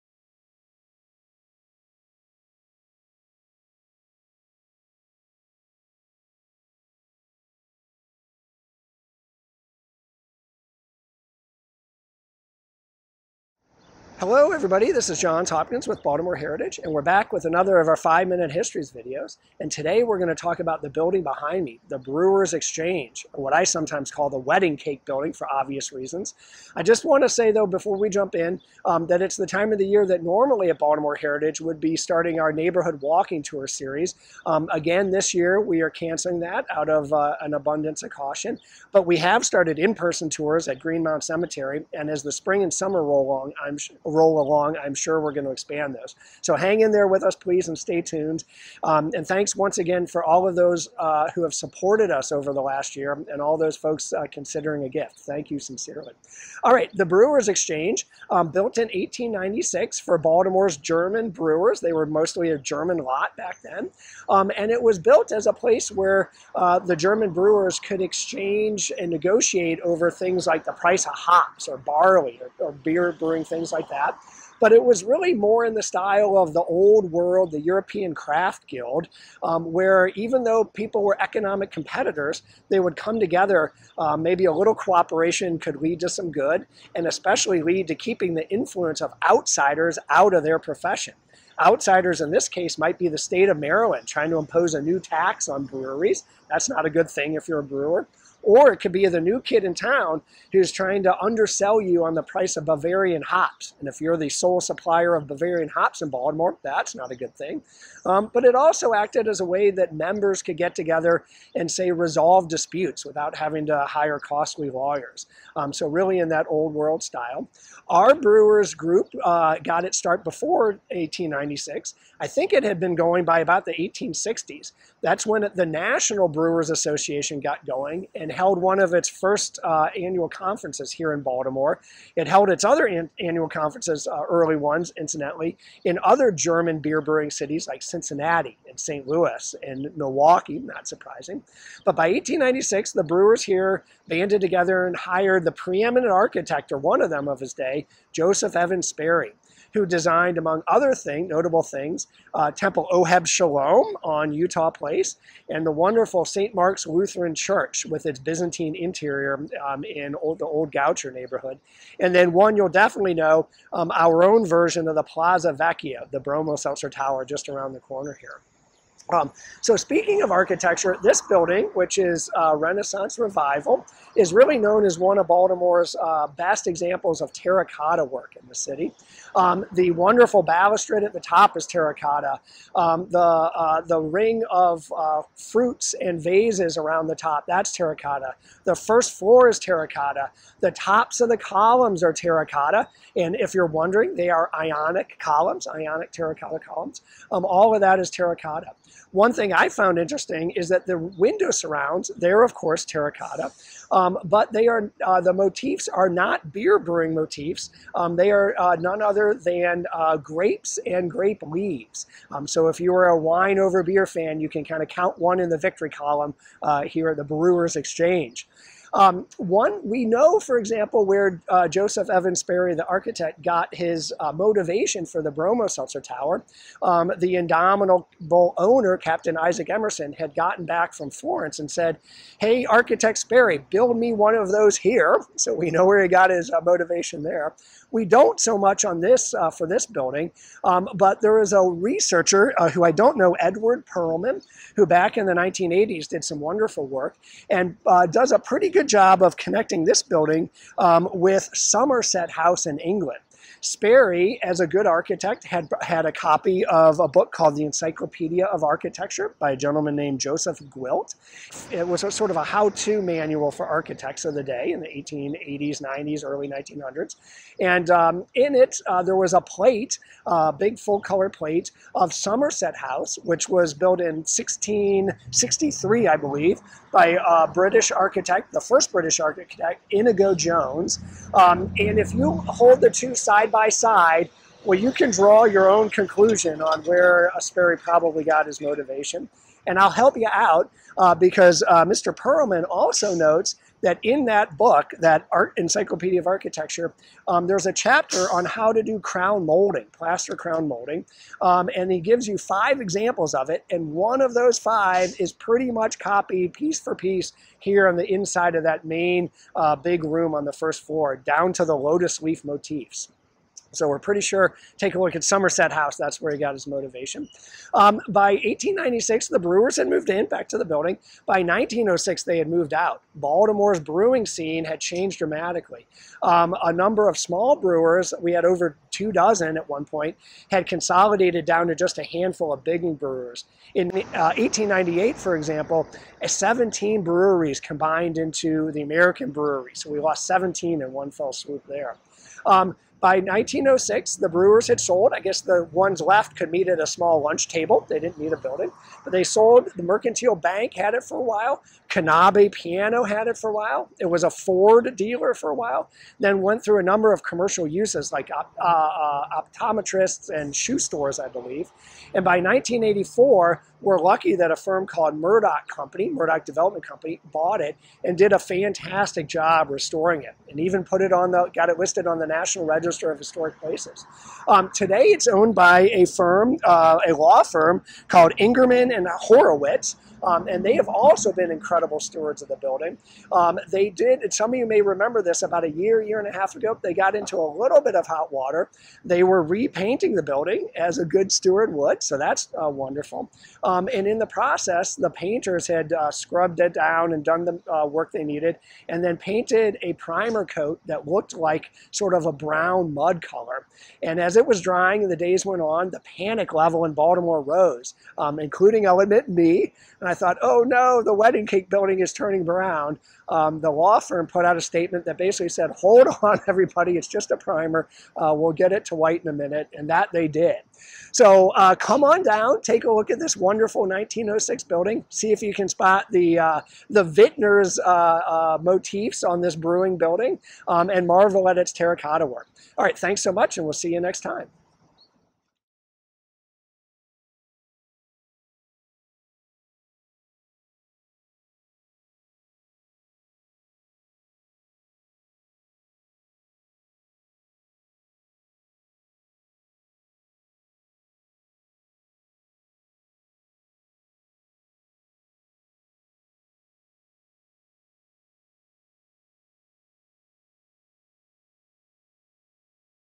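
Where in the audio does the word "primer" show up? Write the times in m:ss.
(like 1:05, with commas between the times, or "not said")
6:39, 6:57.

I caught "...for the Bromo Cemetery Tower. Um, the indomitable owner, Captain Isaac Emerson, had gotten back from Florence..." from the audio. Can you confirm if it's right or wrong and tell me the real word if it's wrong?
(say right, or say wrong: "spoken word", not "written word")
wrong: "Seltzer", not "Cemetery".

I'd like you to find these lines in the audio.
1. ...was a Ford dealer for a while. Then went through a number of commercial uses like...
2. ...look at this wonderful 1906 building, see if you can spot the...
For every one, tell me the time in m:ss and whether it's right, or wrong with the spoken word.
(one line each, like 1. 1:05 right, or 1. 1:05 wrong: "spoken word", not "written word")
1. 5:54 right
2. 7:02 right.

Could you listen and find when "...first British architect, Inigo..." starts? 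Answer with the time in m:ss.
4:38.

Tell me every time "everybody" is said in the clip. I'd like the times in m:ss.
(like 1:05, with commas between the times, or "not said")
0:14, 6:56.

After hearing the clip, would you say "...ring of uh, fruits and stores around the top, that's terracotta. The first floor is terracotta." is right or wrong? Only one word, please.
wrong.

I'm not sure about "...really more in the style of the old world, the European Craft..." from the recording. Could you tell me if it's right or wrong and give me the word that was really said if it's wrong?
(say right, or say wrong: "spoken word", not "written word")
right.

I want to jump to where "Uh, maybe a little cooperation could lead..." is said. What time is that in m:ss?
1:23.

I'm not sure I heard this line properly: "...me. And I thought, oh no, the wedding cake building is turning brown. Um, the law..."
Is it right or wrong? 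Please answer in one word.
right.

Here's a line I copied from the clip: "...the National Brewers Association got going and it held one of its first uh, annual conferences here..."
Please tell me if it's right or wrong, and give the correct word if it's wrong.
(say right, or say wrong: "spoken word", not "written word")
right.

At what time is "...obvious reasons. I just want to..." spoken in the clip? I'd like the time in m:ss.
0:25.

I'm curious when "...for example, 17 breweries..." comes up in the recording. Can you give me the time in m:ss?
5:35.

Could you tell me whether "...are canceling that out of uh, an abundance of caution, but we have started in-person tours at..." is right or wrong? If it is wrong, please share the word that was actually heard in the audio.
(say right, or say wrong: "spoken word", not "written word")
right.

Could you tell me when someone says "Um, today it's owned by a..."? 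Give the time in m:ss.
6:14.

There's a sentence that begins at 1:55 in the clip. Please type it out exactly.
Um, so really in that old world style.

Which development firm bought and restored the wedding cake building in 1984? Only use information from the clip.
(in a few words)
Murdoch Development Company.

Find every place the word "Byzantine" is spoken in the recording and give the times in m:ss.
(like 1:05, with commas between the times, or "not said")
2:38.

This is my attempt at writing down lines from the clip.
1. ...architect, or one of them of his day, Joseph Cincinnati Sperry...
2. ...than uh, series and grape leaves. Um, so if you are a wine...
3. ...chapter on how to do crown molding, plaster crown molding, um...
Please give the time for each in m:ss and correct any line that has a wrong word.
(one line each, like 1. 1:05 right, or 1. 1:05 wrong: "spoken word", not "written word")
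1. 2:26 wrong: "Evans", not "Cincinnati"
2. 3:29 wrong: "grapes", not "series"
3. 4:57 right.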